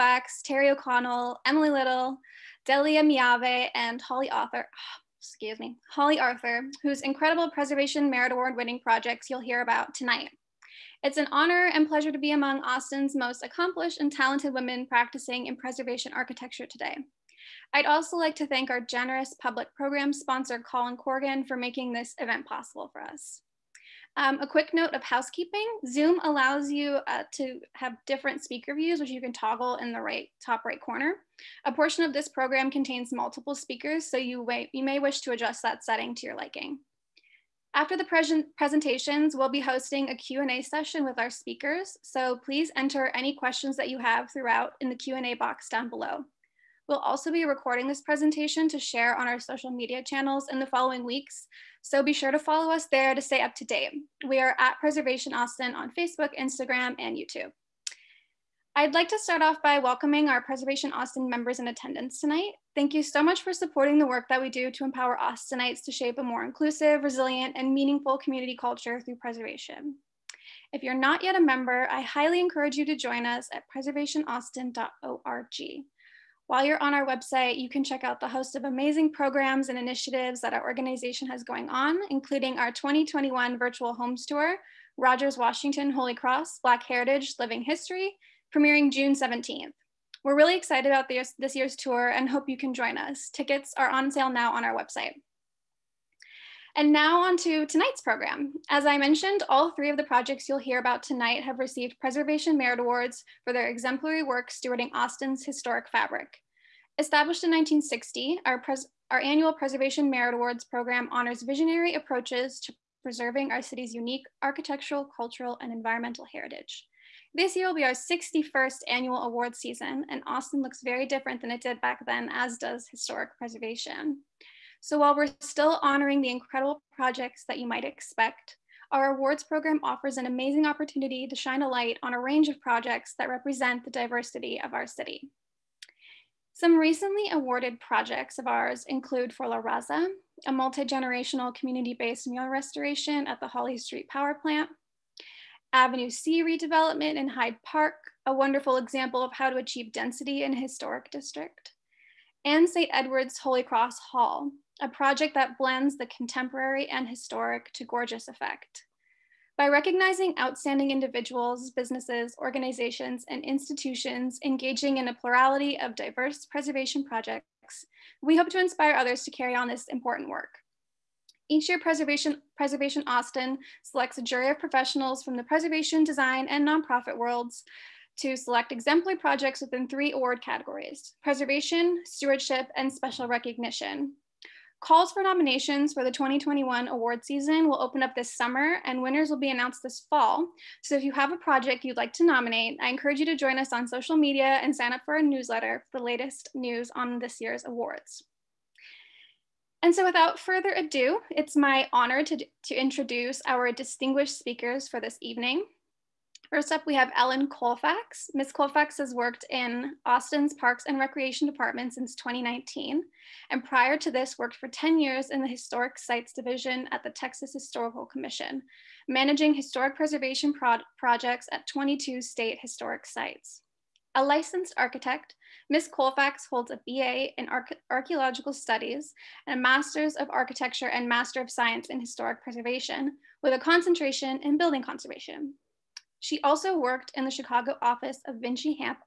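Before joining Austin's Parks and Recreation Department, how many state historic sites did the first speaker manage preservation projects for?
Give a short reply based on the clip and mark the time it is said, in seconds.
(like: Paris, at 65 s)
22, at 221 s.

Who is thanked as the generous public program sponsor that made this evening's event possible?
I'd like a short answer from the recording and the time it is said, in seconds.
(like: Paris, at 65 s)
Colin Corgan, at 20 s.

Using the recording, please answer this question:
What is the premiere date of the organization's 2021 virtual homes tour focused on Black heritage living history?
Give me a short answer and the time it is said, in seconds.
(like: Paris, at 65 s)
June 17th, at 88 s.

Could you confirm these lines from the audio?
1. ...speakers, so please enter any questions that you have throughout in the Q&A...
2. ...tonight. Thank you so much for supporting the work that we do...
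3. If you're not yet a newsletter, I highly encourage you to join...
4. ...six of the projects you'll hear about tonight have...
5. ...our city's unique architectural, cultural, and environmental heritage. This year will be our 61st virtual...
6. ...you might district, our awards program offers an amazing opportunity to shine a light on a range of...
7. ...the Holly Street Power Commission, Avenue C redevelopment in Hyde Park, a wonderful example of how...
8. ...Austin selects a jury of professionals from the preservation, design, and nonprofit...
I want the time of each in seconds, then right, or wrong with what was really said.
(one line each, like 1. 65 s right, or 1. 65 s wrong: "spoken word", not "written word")
1. 41 s right
2. 62 s right
3. 70 s wrong: "member", not "newsletter"
4. 99 s wrong: "three", not "six"
5. 113 s wrong: "annual", not "virtual"
6. 127 s wrong: "expect", not "district"
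7. 143 s wrong: "Plant", not "Commission"
8. 173 s right.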